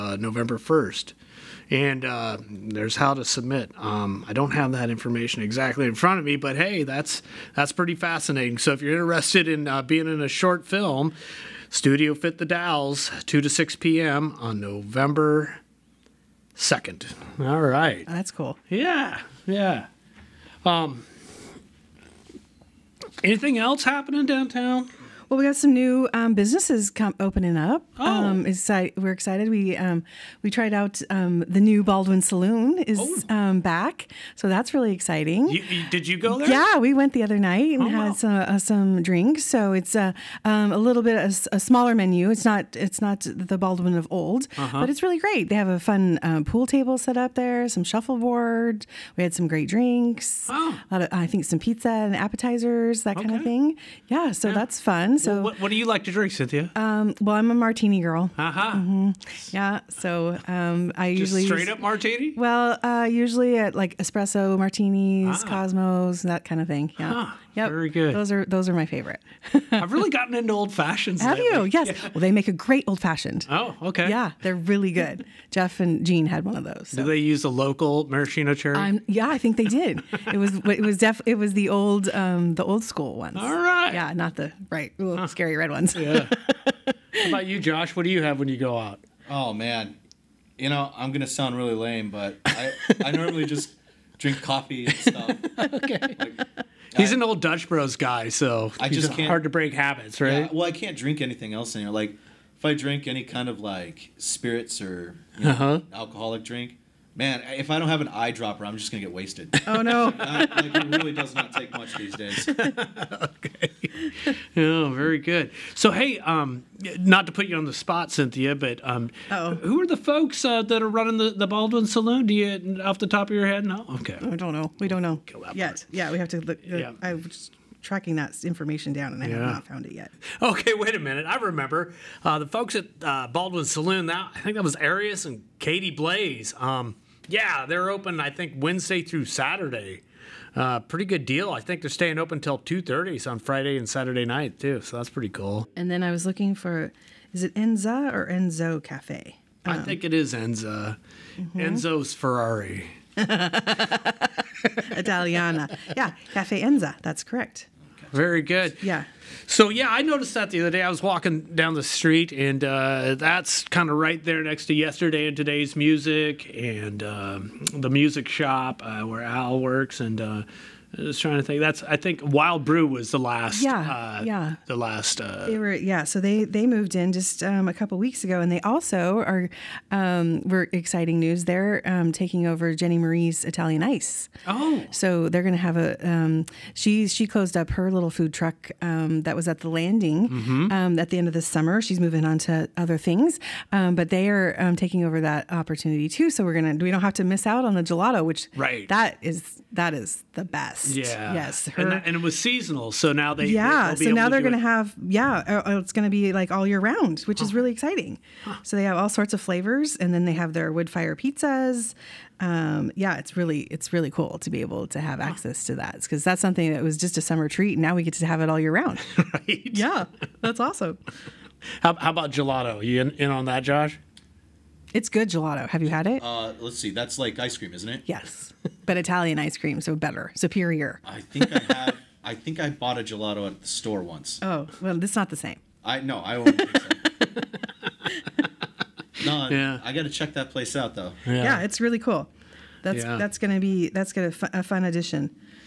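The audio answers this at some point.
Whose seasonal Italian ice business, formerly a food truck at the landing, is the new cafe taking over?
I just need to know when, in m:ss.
3:02.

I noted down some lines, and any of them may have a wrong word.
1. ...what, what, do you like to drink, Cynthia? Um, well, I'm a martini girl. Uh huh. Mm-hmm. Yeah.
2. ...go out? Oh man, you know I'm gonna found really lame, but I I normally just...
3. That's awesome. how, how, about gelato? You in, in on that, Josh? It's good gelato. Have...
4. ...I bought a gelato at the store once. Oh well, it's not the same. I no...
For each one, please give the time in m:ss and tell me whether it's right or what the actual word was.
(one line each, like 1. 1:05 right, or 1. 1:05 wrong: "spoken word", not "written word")
1. 0:55 right
2. 1:28 wrong: "sound", not "found"
3. 3:40 right
4. 3:52 right.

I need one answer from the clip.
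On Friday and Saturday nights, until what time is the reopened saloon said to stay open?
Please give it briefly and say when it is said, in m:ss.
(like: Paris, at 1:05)
2:30, at 2:22.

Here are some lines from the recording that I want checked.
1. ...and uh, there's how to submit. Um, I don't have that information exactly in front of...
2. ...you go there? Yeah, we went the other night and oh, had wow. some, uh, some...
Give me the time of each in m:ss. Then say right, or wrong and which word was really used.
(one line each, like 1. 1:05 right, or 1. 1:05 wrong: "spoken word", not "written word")
1. 0:01 right
2. 0:36 right.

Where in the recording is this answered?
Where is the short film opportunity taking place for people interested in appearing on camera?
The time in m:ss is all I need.
0:11.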